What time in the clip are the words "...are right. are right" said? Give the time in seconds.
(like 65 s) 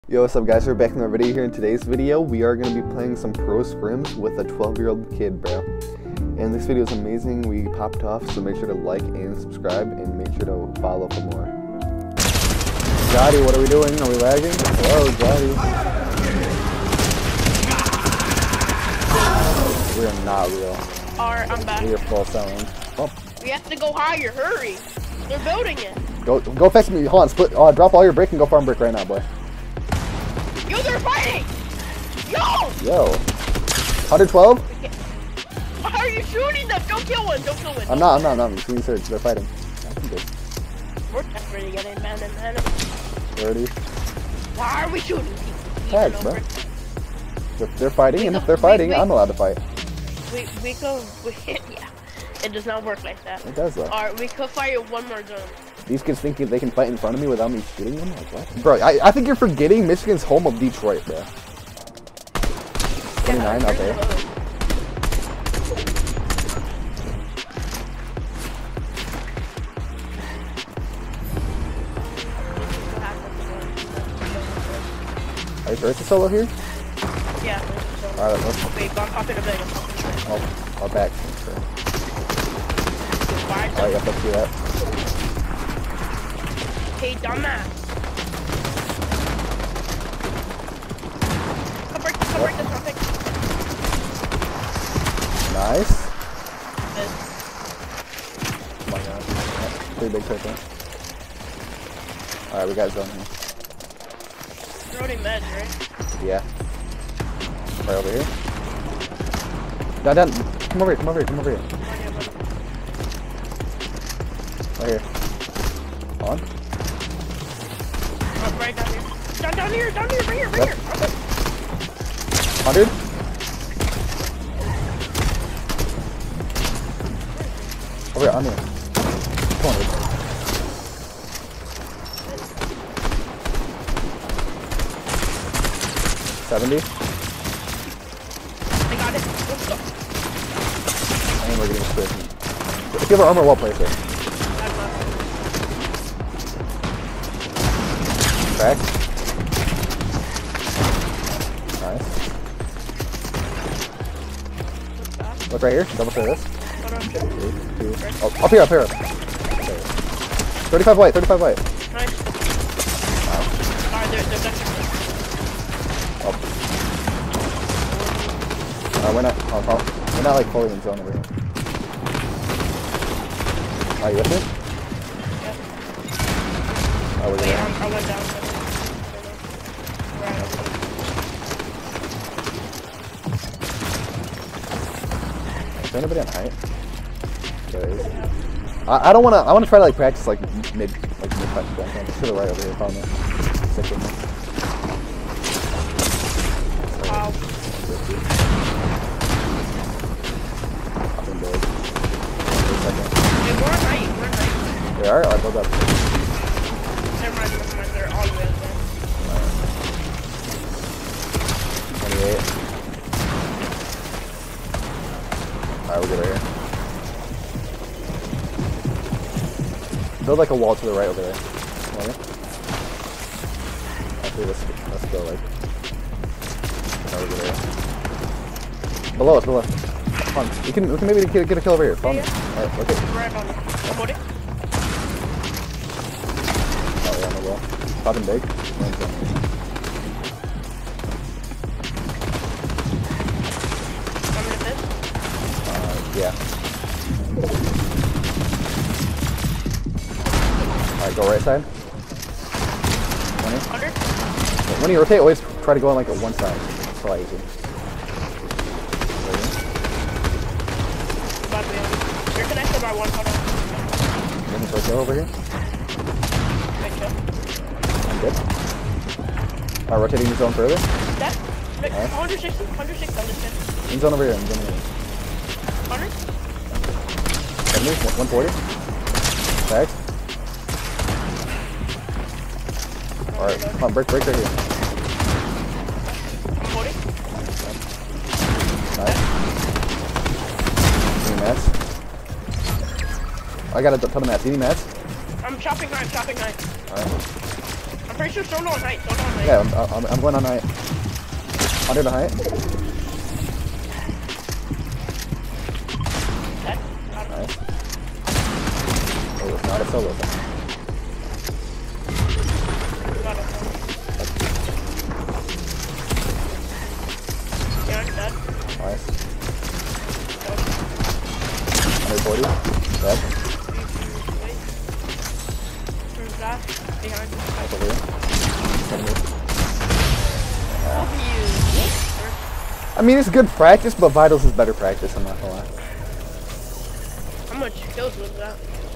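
203 s.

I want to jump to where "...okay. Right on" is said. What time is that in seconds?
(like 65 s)
232 s.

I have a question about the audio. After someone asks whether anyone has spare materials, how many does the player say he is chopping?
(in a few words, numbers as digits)
9.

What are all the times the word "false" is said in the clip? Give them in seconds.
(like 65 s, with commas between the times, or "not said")
21 s.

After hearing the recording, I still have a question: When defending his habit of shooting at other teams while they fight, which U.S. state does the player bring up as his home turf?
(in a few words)
Michigan.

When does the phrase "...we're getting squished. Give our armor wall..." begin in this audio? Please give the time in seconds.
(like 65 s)
141 s.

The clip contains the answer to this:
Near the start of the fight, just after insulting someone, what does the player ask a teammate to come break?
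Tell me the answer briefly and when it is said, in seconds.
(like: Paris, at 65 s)
The rocket, at 92 s.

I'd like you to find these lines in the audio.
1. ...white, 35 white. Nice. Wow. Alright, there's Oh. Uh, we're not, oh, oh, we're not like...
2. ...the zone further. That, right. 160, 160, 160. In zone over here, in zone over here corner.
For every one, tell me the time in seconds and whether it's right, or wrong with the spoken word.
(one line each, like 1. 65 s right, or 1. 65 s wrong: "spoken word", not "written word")
1. 160 s right
2. 270 s right.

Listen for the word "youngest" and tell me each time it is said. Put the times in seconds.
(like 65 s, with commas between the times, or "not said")
not said.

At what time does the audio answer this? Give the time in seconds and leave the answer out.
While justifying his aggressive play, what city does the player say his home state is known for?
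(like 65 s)
60 s.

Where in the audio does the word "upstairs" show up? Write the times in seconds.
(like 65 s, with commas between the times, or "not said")
not said.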